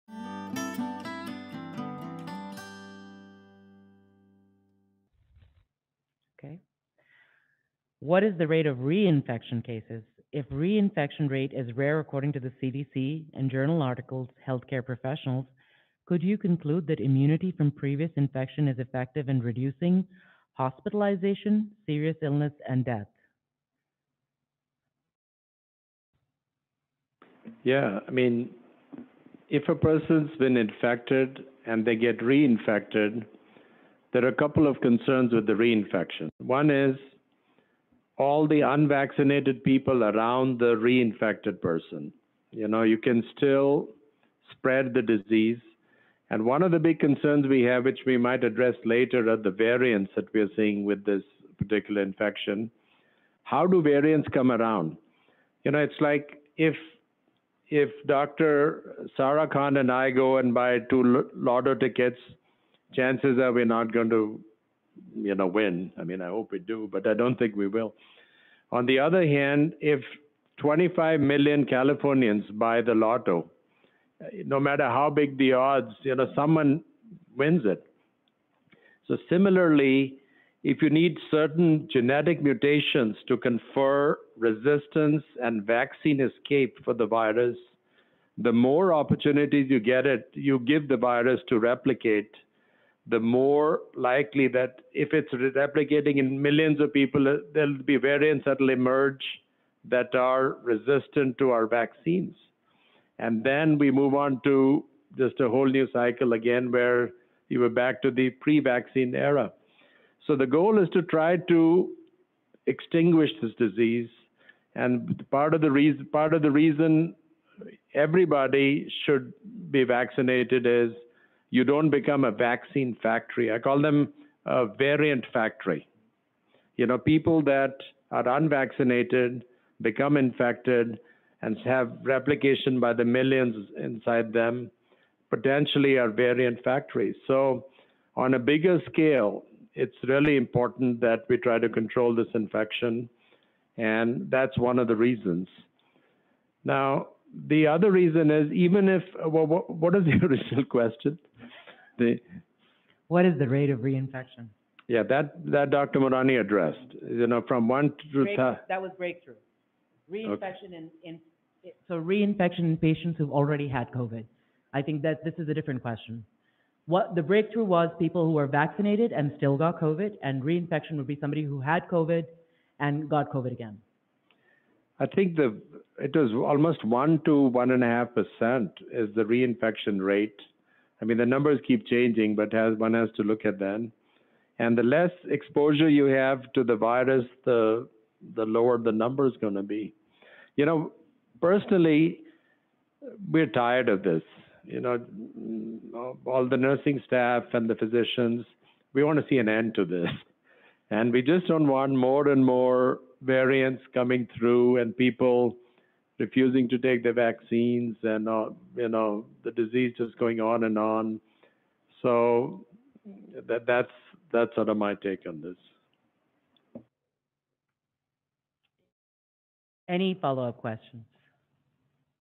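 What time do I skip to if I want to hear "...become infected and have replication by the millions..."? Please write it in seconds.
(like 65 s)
129 s.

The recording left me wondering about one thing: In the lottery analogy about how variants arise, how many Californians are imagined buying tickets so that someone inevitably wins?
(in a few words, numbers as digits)
25 million.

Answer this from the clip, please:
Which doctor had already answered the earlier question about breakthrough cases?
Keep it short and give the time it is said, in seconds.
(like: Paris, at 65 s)
Dr. Mourani, at 155 s.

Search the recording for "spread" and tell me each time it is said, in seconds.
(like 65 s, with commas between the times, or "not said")
44 s.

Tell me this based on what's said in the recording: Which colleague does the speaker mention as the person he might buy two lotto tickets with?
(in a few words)
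Dr. Sara Khan.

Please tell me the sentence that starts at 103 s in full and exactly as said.
And then we move on to just a whole new cycle again where you were back to the pre vaccine era.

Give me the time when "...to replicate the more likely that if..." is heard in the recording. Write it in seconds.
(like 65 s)
91 s.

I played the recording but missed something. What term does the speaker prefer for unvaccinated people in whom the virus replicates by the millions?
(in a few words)
variant factory.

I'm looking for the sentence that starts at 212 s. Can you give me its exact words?
So that, that's that's sort of my take on this.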